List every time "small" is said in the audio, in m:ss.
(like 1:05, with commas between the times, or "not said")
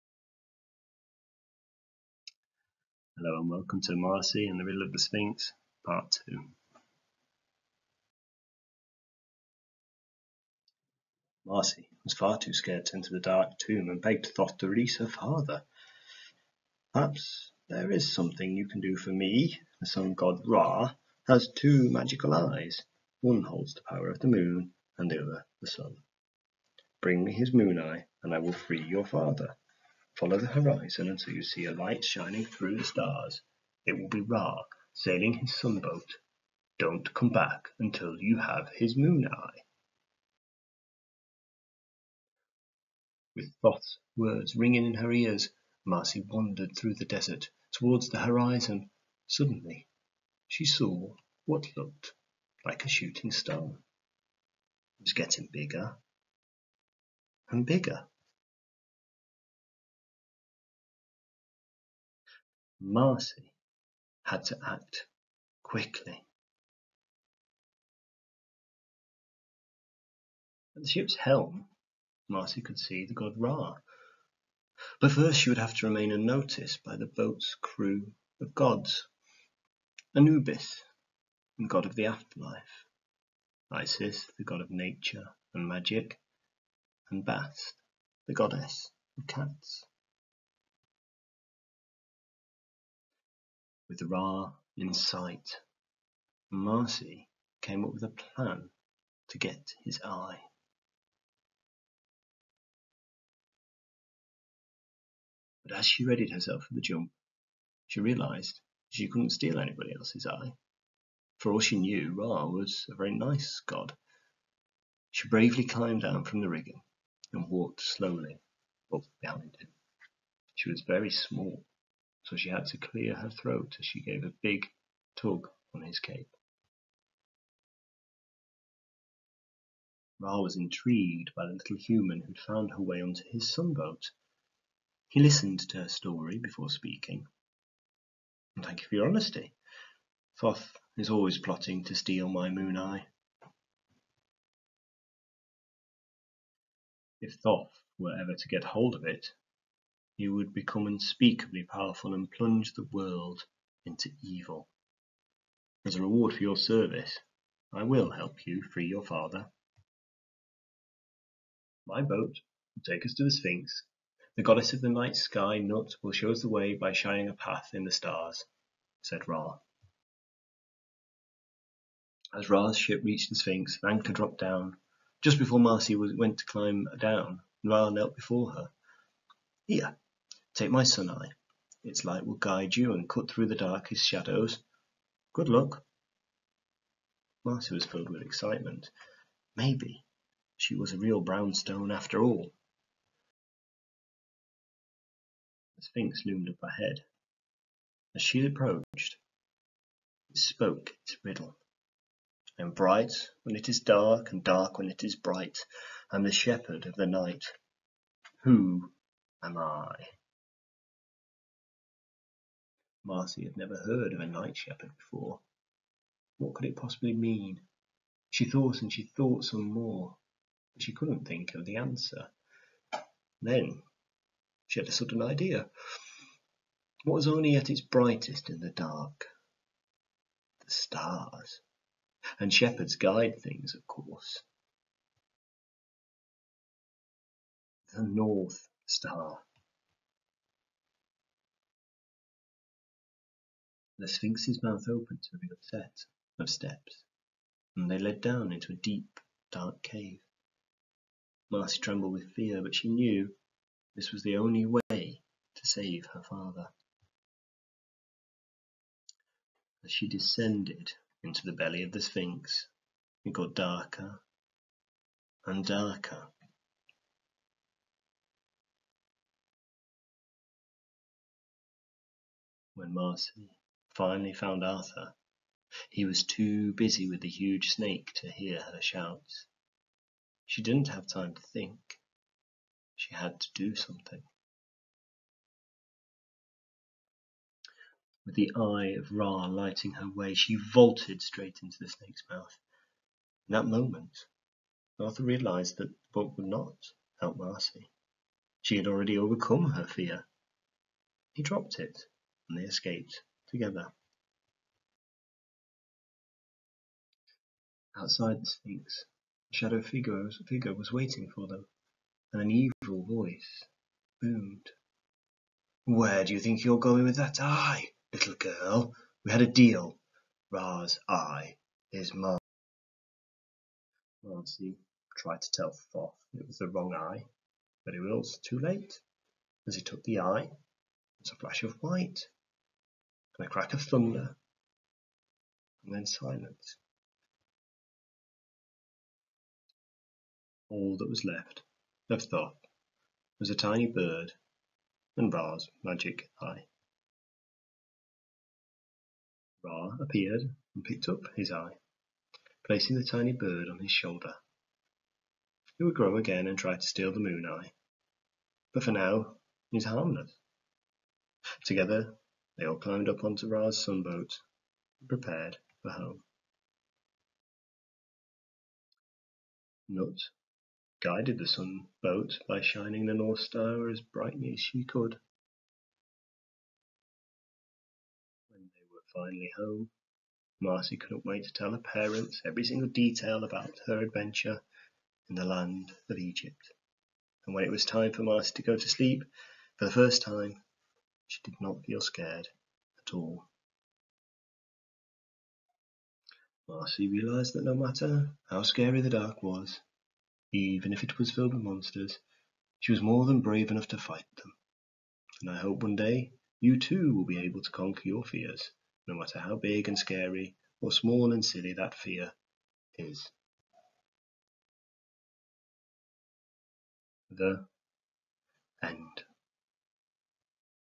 2:01, 6:50.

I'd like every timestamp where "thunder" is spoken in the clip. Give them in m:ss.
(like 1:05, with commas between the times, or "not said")
5:33.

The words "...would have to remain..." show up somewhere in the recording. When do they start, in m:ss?
1:15.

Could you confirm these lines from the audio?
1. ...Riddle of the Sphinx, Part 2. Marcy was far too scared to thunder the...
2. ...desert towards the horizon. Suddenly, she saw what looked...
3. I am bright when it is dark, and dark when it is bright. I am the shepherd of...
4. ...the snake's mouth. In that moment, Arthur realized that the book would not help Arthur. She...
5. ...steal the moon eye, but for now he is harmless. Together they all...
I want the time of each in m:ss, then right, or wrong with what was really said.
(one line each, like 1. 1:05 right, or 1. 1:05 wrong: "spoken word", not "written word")
1. 0:04 wrong: "enter", not "thunder"
2. 0:47 right
3. 3:22 right
4. 4:51 wrong: "Marcy", not "Arthur"
5. 5:56 right.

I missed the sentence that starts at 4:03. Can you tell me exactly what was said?
The sphinx's mouth opened to reveal a set of steps, and they led down into a deep, dark cave.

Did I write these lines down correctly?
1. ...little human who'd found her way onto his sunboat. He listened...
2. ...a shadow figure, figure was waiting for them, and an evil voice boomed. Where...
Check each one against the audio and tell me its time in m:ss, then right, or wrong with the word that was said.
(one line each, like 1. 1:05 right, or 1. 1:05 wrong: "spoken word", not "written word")
1. 2:11 right
2. 5:09 right.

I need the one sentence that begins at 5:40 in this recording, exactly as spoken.
All that was left of Thoth was a tiny bird and Ra's magic eye.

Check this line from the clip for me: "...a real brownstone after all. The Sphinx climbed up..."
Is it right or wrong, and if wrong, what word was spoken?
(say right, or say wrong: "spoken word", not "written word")
wrong: "loomed", not "climbed".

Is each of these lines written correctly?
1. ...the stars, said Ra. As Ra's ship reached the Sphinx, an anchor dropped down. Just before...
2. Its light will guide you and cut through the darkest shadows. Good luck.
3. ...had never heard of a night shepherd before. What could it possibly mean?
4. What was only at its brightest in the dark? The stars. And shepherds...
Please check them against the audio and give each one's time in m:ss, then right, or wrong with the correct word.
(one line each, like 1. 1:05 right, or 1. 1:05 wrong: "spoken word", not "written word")
1. 2:47 right
2. 3:01 right
3. 3:33 right
4. 3:47 right.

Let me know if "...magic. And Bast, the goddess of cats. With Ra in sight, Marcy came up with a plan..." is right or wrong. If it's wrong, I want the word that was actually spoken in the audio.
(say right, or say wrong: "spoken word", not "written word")
right.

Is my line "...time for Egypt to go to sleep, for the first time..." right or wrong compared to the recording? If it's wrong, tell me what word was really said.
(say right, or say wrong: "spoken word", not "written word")
wrong: "Marcy", not "Egypt".